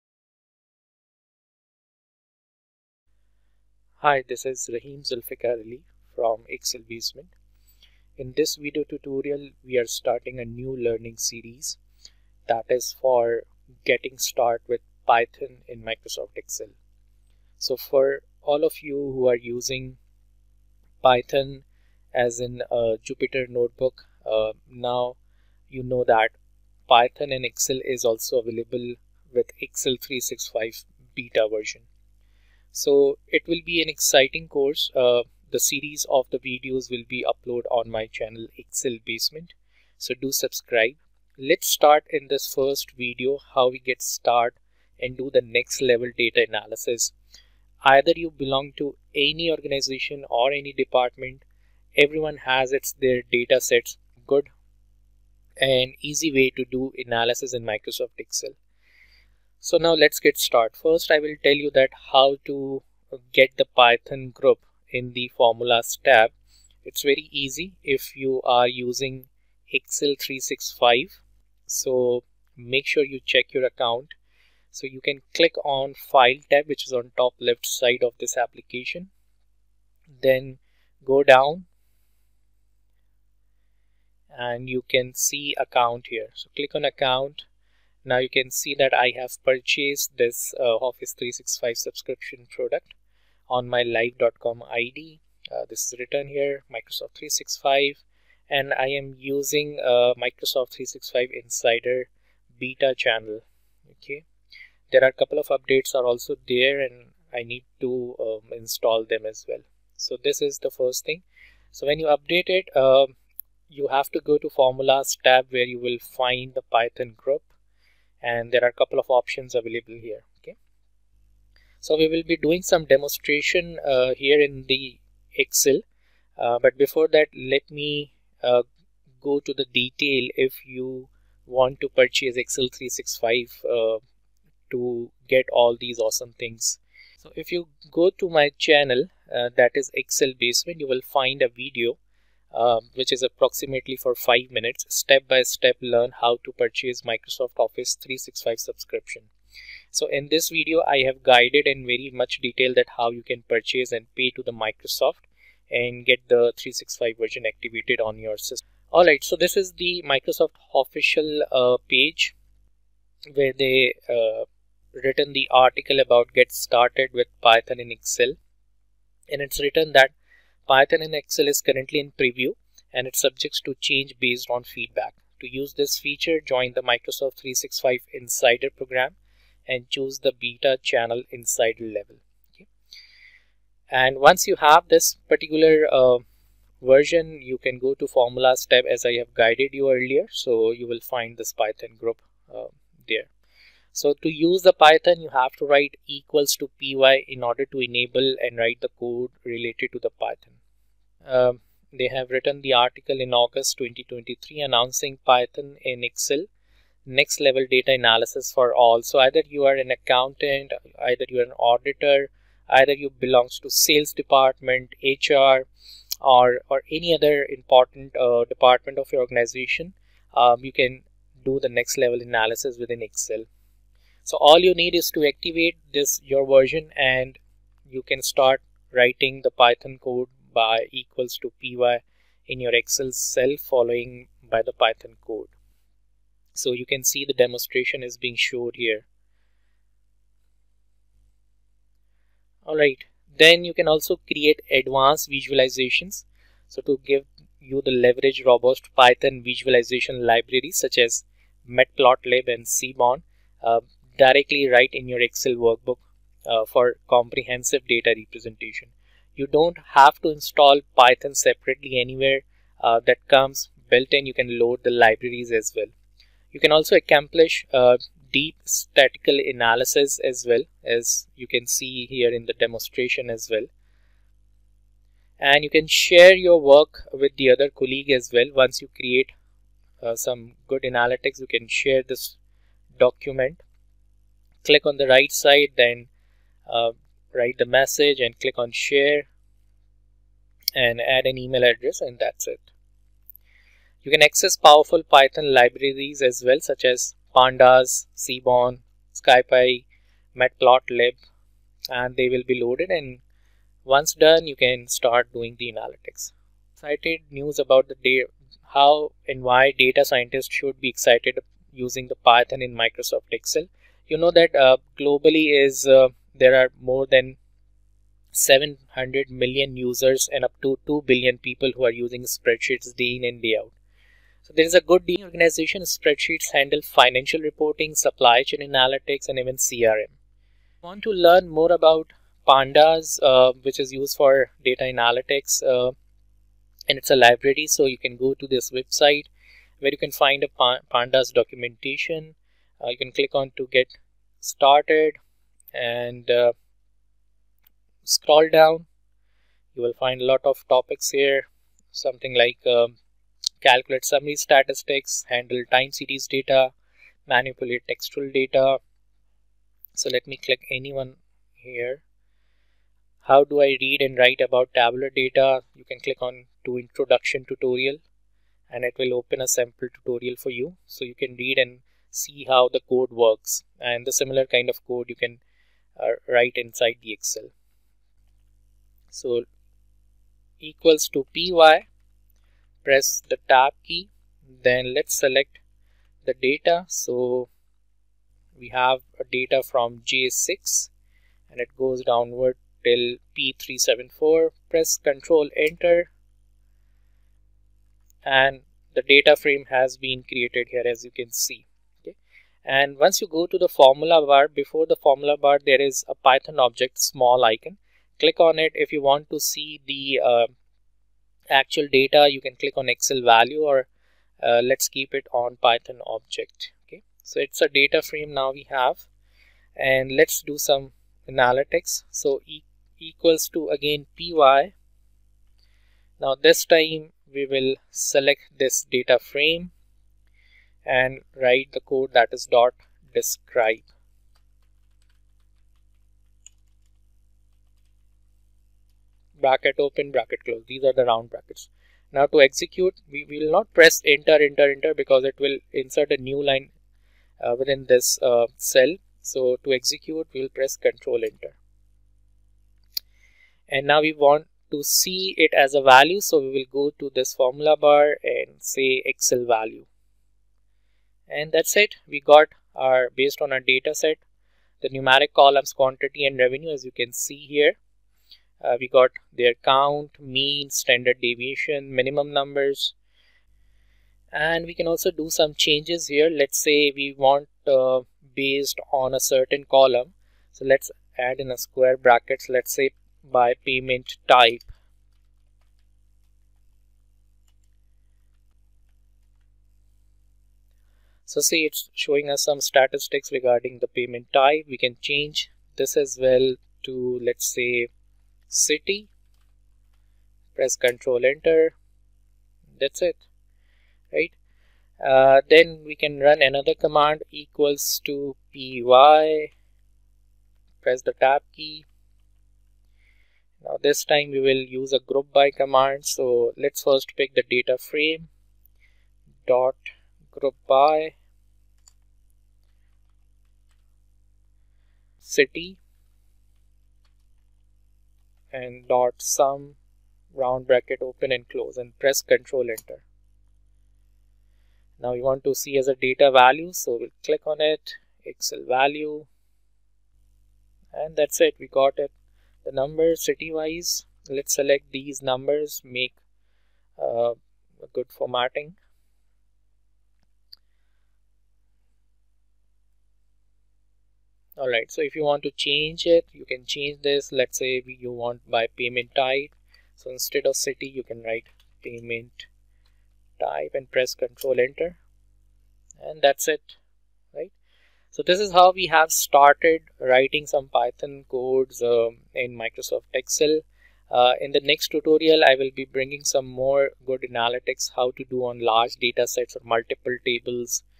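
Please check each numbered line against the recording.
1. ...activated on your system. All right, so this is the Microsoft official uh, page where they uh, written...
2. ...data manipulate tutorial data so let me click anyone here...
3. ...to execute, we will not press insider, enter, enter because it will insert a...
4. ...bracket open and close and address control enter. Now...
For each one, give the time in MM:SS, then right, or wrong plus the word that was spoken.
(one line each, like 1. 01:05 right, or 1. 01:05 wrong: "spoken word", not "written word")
1. 02:37 right
2. 05:56 wrong: "textual", not "tutorial"
3. 07:22 wrong: "enter", not "insider"
4. 08:50 wrong: "press", not "address".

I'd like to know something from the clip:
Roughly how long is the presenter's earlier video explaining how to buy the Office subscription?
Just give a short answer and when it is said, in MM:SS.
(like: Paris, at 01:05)
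5 minutes, at 02:24.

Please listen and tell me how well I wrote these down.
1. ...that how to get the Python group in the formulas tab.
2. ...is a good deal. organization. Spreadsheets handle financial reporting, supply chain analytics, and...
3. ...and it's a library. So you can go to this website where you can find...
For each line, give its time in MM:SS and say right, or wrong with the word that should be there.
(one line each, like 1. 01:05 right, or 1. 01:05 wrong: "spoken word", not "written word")
1. 01:01 right
2. 05:24 right
3. 05:36 right.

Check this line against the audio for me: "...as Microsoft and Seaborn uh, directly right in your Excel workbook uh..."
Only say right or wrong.
wrong.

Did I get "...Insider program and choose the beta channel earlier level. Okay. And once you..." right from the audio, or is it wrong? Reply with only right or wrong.
wrong.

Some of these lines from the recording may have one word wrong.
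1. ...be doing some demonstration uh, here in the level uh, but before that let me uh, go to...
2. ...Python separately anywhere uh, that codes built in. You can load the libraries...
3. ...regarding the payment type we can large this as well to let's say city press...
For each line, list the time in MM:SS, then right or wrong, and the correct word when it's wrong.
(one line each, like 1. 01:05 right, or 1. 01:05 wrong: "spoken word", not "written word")
1. 02:02 wrong: "excel", not "level"
2. 04:20 wrong: "comes", not "codes"
3. 08:13 wrong: "change", not "large".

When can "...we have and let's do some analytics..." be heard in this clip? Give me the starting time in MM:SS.
06:58.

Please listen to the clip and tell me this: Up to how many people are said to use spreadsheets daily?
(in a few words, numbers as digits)
2 billion.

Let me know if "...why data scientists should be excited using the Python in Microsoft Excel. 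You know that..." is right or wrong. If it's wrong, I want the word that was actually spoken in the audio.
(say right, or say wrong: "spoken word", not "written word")
right.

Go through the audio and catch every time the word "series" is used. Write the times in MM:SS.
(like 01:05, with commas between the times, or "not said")
00:11, 00:35, 05:55.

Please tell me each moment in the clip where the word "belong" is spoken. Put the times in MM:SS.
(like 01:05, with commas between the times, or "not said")
00:48, 03:33.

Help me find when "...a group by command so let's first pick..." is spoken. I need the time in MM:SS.
08:34.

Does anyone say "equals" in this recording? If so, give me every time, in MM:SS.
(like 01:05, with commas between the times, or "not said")
03:16, 03:50, 06:20, 07:02, 08:27.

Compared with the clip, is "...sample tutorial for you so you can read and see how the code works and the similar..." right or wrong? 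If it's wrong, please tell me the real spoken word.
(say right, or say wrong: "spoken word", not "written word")
right.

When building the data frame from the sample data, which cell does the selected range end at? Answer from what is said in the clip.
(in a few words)
P374.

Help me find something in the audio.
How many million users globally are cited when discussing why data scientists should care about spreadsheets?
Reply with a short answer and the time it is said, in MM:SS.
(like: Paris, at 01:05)
700 million, at 05:18.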